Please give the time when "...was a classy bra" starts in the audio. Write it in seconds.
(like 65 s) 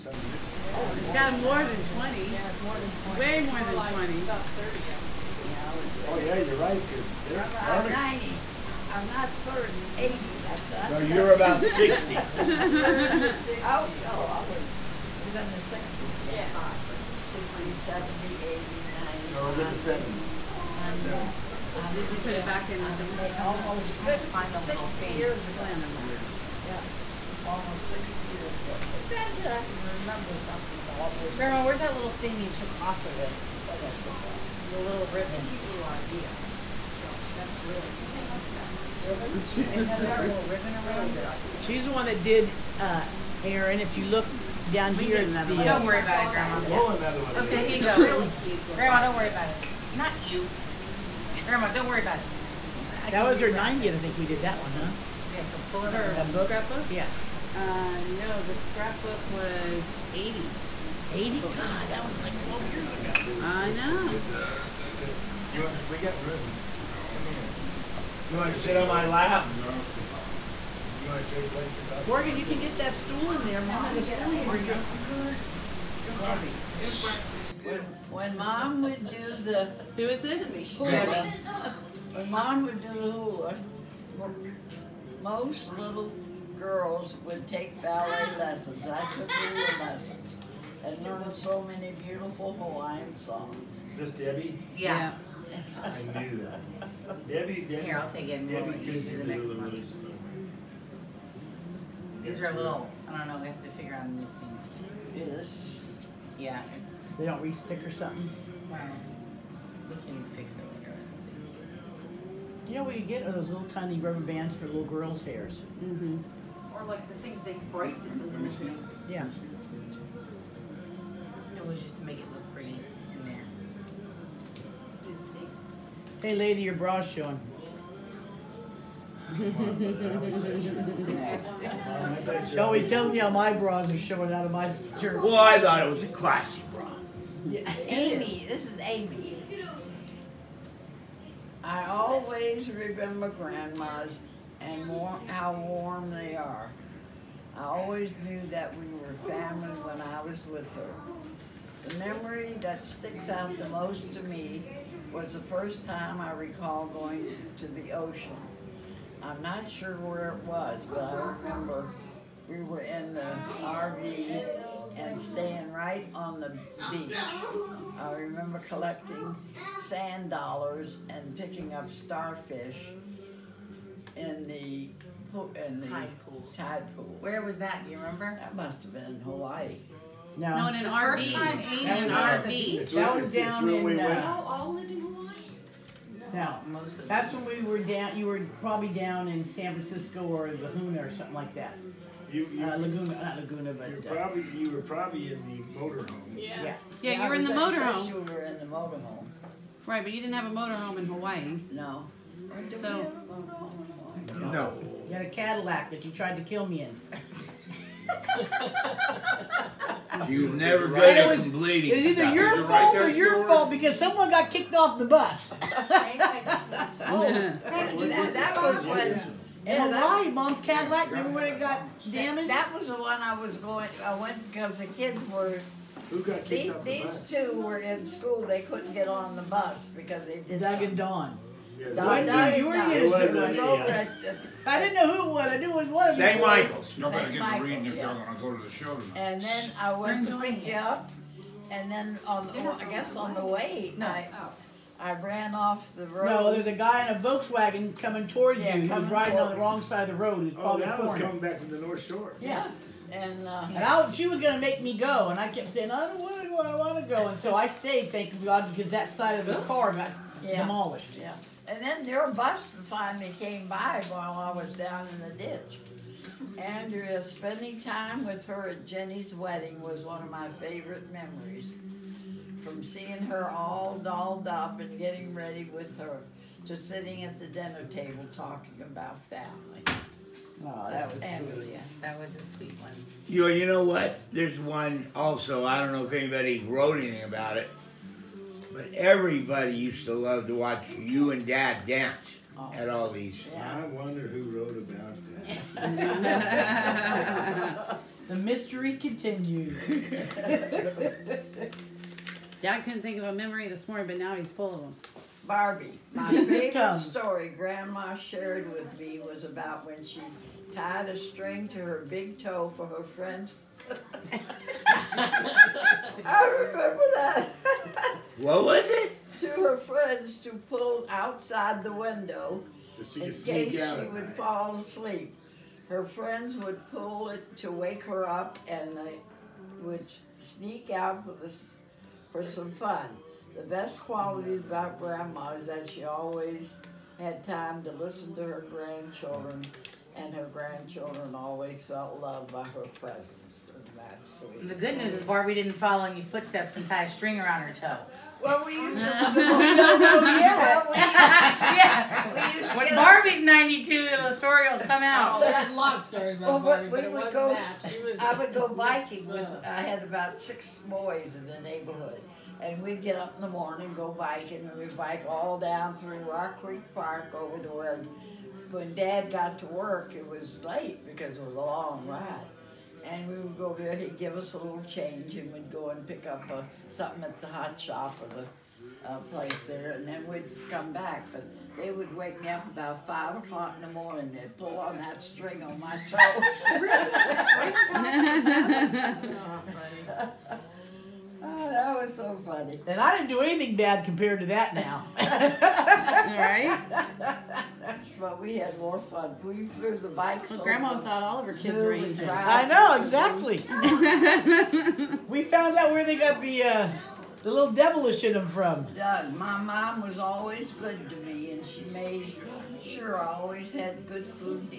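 135 s.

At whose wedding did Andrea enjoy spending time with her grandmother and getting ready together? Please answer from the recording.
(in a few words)
Jenny's.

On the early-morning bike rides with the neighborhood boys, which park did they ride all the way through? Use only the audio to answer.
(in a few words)
Rock Creek Park.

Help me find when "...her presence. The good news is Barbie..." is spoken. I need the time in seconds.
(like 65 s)
342 s.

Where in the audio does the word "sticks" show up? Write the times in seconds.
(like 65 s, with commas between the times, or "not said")
107 s, 125 s, 152 s.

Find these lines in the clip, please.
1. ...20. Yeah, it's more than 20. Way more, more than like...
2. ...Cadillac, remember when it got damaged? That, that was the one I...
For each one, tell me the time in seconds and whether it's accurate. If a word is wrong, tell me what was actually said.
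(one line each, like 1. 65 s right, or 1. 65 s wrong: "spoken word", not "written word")
1. 1 s right
2. 220 s right.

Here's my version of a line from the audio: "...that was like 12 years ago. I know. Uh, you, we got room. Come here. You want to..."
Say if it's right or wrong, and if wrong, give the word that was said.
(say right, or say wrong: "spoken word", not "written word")
right.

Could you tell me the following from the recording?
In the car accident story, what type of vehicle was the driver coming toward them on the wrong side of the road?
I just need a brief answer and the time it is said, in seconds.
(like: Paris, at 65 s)
Volkswagen, at 247 s.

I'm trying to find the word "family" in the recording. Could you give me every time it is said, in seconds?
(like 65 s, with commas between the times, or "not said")
149 s, 279 s.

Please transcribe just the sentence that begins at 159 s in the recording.
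I'm not sure where it was, but I remember we were in the RV and staying right on the beach.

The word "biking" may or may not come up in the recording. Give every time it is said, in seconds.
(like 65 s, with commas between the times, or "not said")
358 s, 364 s.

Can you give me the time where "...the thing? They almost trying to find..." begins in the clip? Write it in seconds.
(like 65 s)
22 s.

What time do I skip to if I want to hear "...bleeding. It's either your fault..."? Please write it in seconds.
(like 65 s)
211 s.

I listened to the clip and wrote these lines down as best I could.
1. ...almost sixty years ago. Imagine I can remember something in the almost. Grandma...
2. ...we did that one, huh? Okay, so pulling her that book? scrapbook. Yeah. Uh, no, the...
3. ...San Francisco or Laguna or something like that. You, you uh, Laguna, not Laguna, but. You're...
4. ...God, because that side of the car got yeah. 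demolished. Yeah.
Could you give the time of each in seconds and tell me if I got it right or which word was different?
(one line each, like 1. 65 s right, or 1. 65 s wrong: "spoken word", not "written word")
1. 27 s right
2. 54 s right
3. 189 s right
4. 258 s right.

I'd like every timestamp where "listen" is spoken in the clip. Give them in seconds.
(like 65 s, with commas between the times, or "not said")
337 s.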